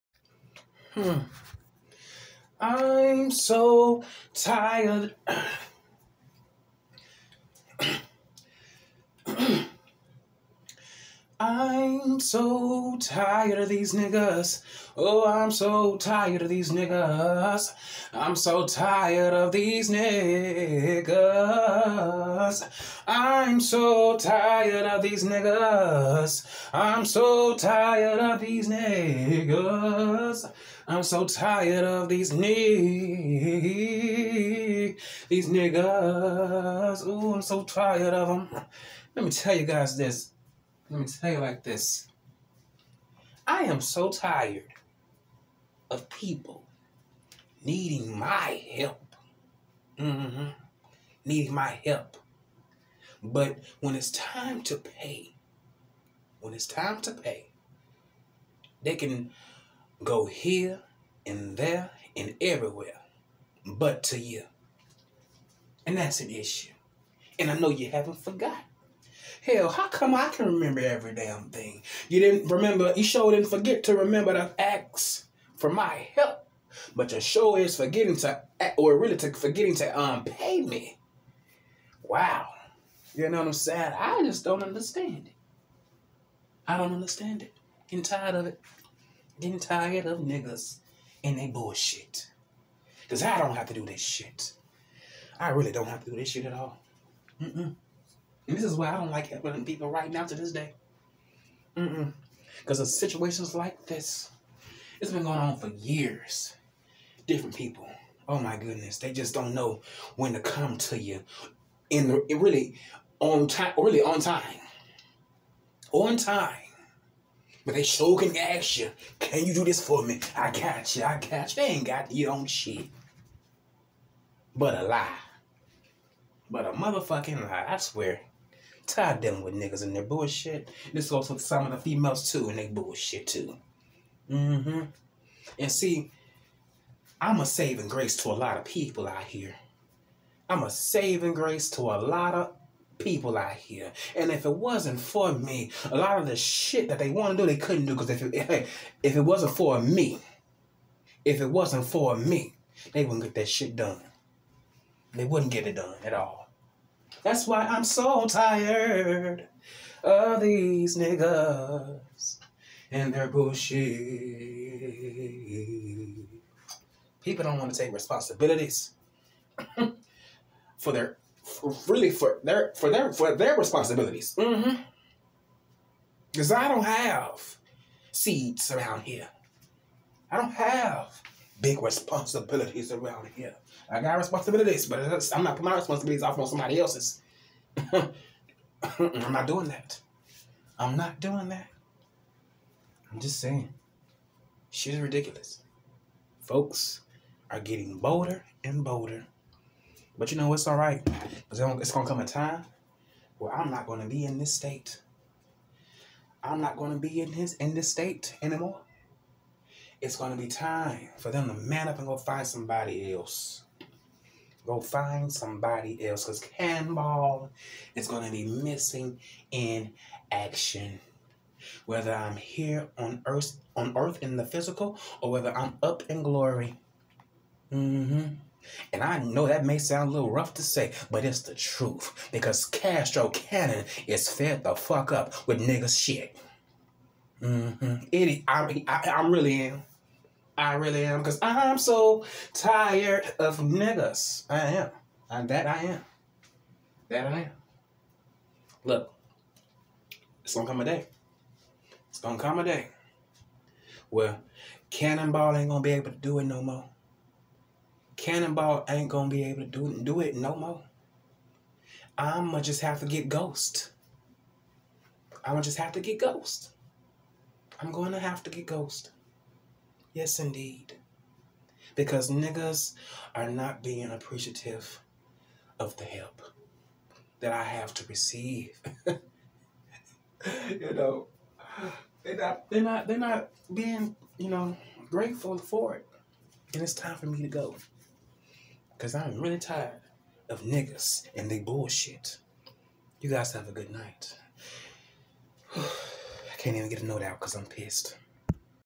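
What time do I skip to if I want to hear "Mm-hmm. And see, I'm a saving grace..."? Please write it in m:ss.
2:14.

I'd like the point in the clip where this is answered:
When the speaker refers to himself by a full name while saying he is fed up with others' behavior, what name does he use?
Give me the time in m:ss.
3:52.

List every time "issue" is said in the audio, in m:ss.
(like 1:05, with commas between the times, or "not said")
1:06.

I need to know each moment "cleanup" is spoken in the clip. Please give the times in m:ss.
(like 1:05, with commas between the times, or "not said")
not said.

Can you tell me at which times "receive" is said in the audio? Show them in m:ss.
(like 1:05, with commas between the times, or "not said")
4:38.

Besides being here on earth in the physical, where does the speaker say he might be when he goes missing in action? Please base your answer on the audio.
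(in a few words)
up in glory.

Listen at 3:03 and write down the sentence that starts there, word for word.
I got responsibilities, but I'm not putting my responsibilities off on somebody else's.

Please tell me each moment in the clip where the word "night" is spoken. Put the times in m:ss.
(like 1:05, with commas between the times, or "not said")
4:53.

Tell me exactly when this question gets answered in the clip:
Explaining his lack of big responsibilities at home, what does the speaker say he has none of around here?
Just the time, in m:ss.
2:58.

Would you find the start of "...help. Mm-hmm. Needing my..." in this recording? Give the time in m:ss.
0:48.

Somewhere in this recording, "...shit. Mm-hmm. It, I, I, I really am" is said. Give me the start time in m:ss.
3:55.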